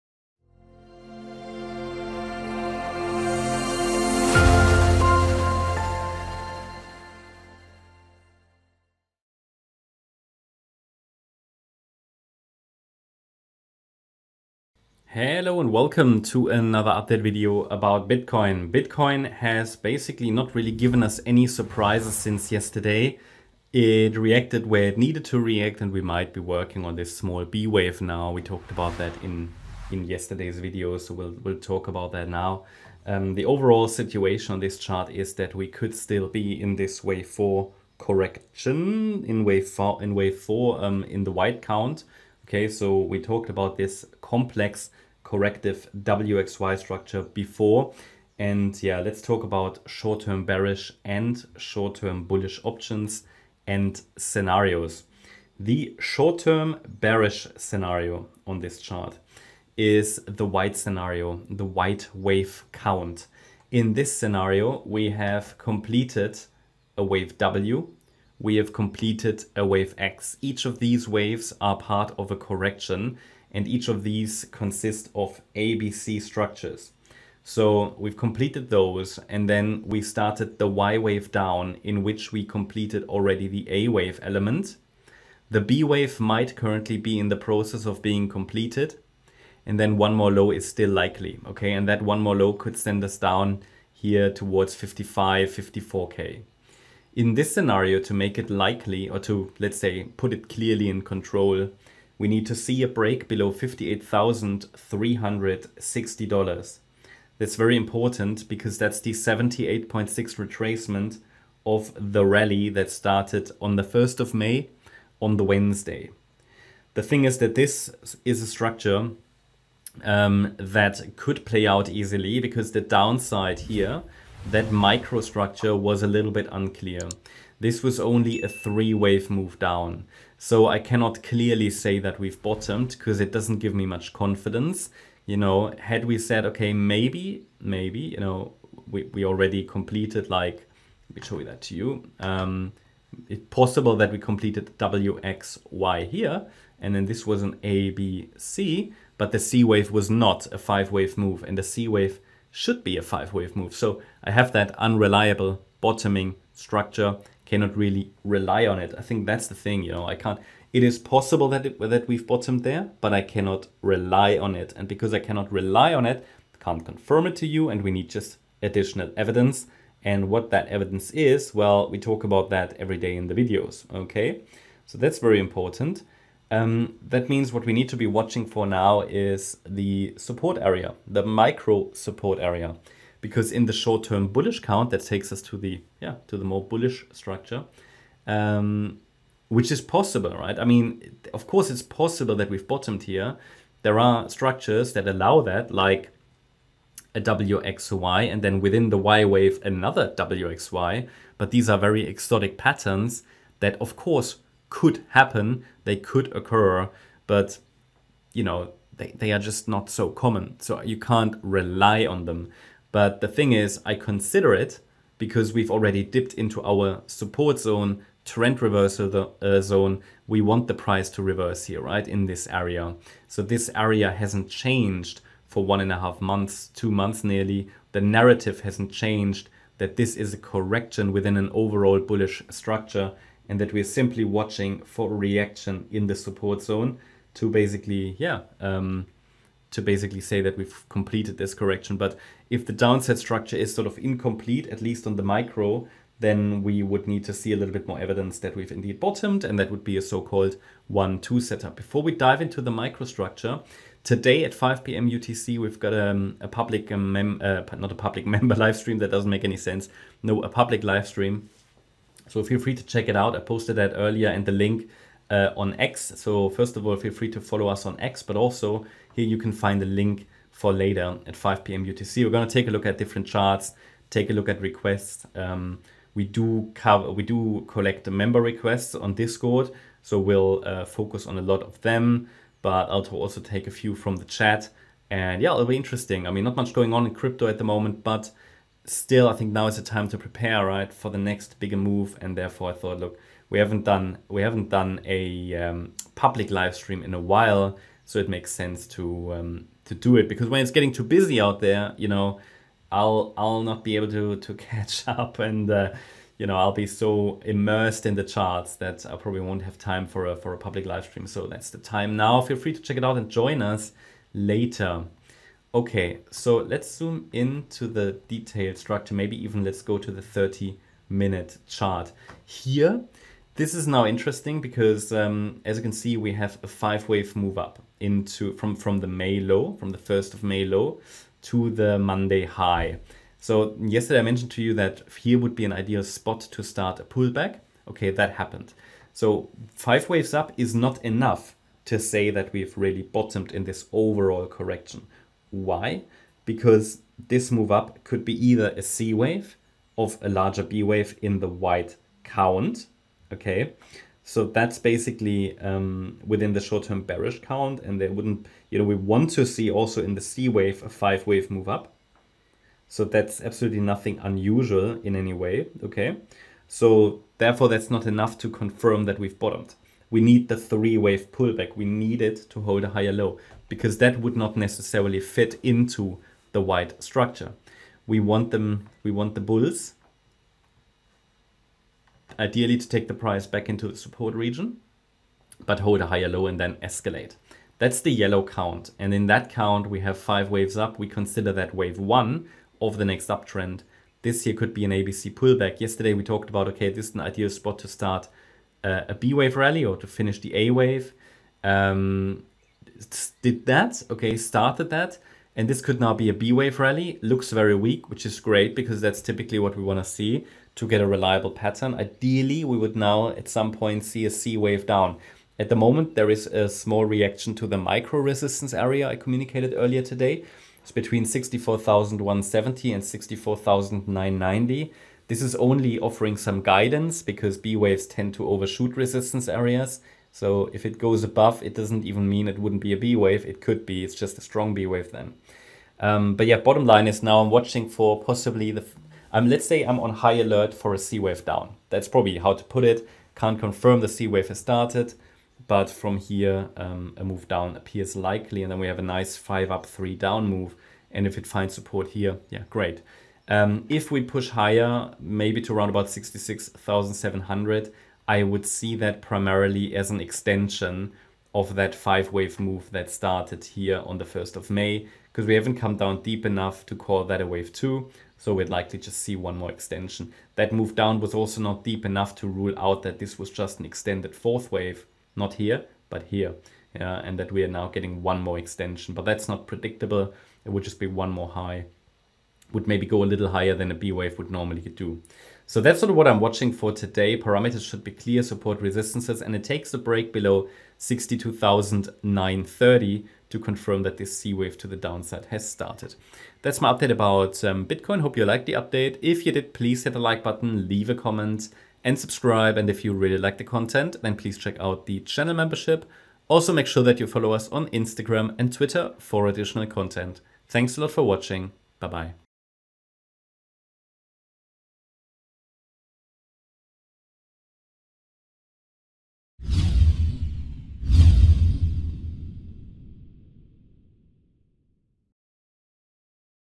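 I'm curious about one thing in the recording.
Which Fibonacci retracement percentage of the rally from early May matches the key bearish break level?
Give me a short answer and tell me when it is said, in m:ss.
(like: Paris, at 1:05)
78.6, at 1:49.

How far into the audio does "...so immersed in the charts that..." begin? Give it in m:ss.
5:06.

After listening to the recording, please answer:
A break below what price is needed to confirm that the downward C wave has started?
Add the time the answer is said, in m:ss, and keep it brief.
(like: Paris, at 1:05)
62,930, at 8:10.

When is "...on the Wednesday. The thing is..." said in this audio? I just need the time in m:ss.
1:55.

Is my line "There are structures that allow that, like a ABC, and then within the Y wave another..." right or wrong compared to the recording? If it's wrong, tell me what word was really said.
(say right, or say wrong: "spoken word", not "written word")
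wrong: "WXY", not "ABC".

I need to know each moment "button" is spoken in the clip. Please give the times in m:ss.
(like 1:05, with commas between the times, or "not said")
8:20.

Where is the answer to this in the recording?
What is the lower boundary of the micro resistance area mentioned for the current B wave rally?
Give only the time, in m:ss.
7:01.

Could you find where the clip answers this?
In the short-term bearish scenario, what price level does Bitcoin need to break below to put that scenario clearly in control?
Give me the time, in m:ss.
1:43.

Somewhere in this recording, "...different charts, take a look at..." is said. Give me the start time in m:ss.
4:32.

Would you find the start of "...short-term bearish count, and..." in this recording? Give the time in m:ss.
5:56.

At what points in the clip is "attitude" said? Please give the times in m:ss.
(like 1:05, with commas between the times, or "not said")
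not said.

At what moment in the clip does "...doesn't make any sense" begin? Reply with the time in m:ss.
4:19.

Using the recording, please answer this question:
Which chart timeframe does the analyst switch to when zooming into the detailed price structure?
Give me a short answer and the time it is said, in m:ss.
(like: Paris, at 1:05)
30 minute, at 5:20.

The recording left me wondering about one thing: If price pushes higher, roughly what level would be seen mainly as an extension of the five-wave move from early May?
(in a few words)
66,700.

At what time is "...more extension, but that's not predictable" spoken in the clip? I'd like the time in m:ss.
7:58.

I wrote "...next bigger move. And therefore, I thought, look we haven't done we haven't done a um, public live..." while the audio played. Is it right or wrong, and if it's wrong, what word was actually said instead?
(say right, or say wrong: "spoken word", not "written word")
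right.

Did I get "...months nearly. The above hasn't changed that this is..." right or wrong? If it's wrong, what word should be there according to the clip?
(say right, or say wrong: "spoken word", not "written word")
wrong: "narrative", not "above".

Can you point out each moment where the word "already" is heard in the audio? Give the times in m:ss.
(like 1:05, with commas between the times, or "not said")
1:23, 2:19, 3:35.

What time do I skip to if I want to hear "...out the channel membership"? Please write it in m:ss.
8:24.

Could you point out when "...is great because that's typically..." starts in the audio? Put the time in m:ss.
6:48.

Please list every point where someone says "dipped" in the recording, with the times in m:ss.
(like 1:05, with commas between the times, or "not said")
3:36.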